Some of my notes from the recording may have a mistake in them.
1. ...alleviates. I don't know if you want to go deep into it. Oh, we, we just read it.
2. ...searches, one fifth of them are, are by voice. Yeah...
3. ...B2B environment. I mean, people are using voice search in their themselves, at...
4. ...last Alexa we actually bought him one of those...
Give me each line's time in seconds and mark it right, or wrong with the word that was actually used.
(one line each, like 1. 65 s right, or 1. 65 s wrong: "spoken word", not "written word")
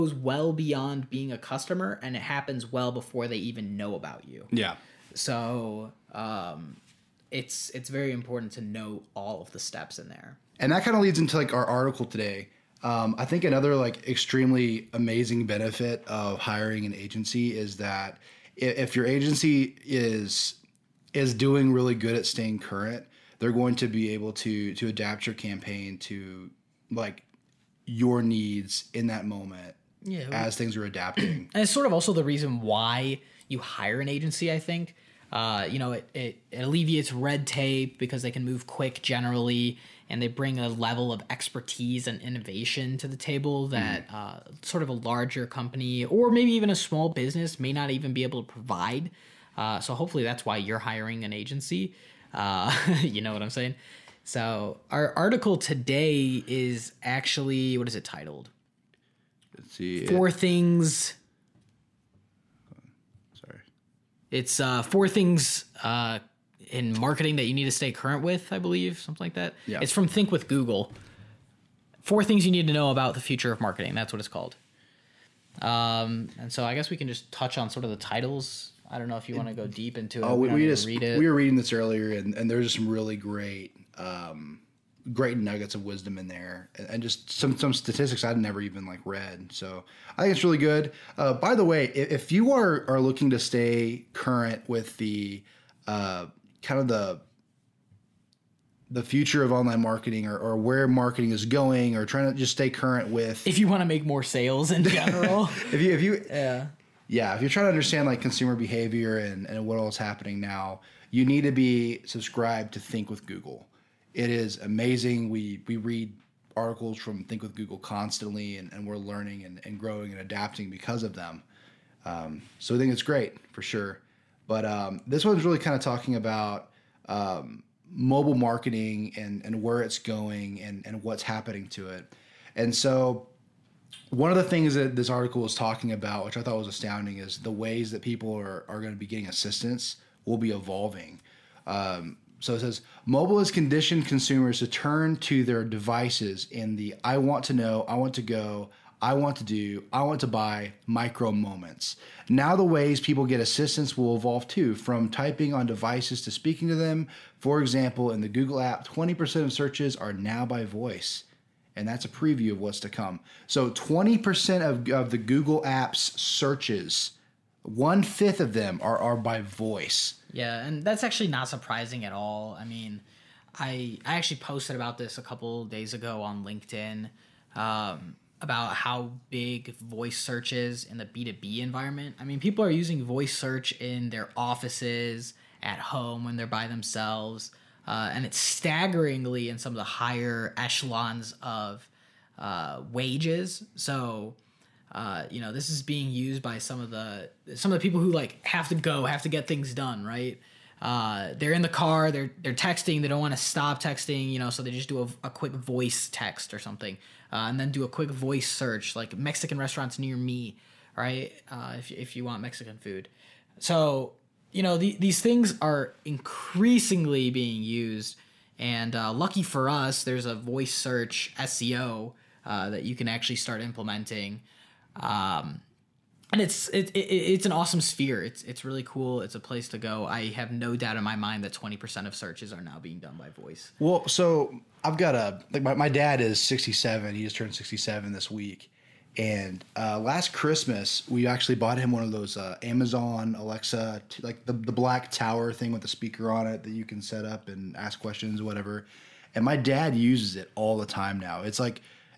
1. 77 s wrong: "titles", not "alleviates"
2. 166 s right
3. 181 s wrong: "offices", not "themselves"
4. 239 s wrong: "Christmas", not "Alexa".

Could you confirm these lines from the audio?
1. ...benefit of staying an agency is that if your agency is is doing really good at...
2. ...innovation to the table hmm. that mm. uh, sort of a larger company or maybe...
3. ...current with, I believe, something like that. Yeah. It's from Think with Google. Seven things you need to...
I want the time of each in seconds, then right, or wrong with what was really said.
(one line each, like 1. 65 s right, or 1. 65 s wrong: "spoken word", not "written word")
1. 15 s wrong: "hiring", not "staying"
2. 42 s right
3. 67 s wrong: "Four", not "Seven".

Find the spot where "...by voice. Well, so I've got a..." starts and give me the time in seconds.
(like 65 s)
233 s.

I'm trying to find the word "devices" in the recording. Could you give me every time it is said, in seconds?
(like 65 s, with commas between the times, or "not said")
145 s, 155 s.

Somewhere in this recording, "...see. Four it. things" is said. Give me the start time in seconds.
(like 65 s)
59 s.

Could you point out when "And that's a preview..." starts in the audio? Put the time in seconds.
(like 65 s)
161 s.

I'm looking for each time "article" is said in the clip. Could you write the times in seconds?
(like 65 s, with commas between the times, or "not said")
11 s, 55 s, 116 s, 135 s.